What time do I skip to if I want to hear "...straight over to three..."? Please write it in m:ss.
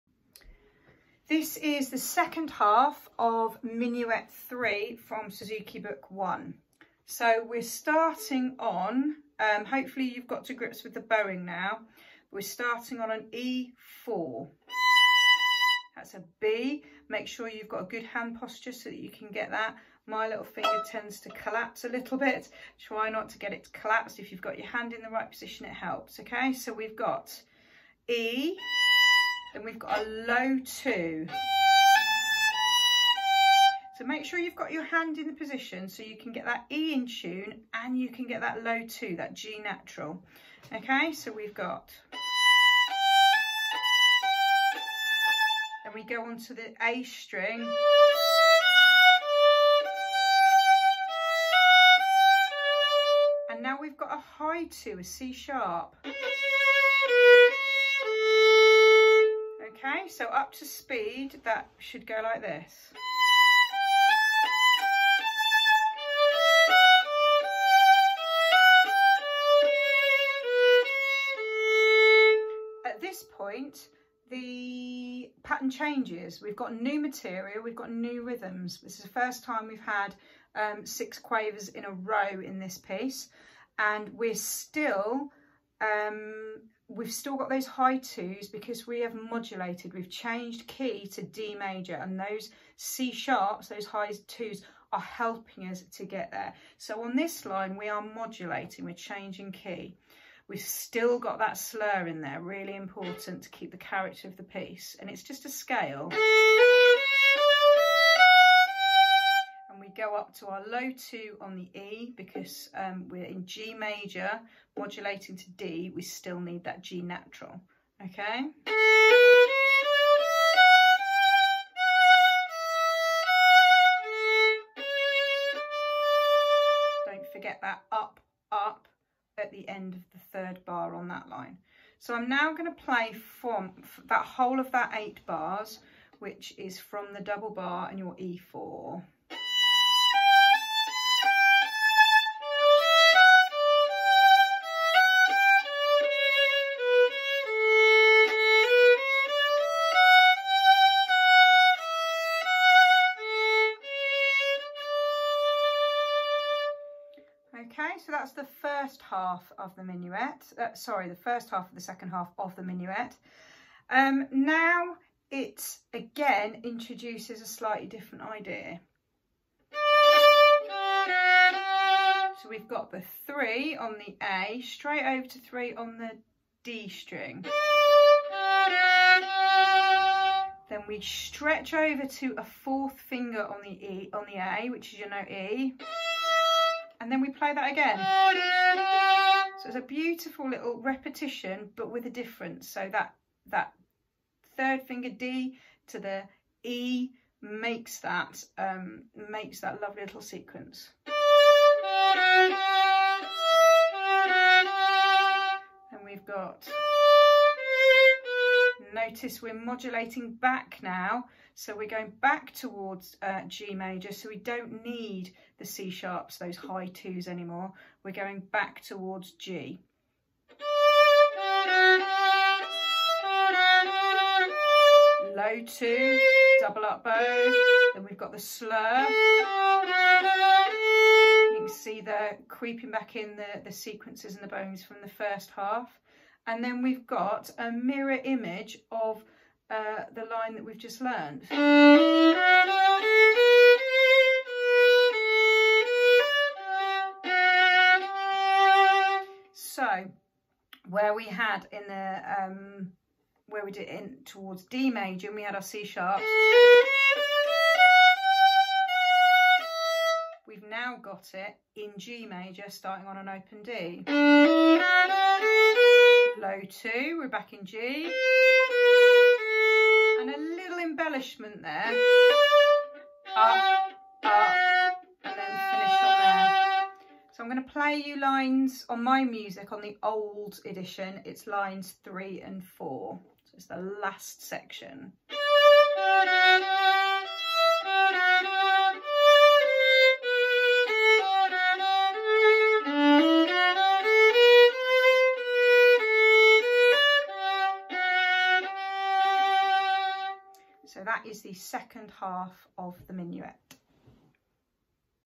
2:54.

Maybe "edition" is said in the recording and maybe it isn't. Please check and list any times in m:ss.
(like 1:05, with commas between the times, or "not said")
4:40.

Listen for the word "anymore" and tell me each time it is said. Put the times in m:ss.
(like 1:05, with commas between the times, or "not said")
3:37.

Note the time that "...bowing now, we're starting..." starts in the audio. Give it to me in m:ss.
0:10.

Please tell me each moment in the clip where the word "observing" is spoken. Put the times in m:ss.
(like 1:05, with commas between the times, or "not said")
not said.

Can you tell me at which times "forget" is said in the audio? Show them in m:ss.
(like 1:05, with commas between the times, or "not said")
2:07.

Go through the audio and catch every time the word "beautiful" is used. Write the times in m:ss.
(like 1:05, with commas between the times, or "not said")
3:09.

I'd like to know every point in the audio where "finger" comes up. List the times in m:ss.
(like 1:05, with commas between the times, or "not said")
0:20, 3:02, 3:14.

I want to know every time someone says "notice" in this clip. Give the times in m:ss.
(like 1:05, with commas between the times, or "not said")
3:28.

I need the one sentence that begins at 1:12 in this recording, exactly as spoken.
At this point, the pattern changes.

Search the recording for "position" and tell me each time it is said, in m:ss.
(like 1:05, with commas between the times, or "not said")
0:25, 0:35.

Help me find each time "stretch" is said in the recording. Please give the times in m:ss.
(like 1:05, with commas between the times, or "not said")
3:00.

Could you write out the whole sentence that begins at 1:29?
We've changed key to D major and those C sharps, those high twos are helping us to get there.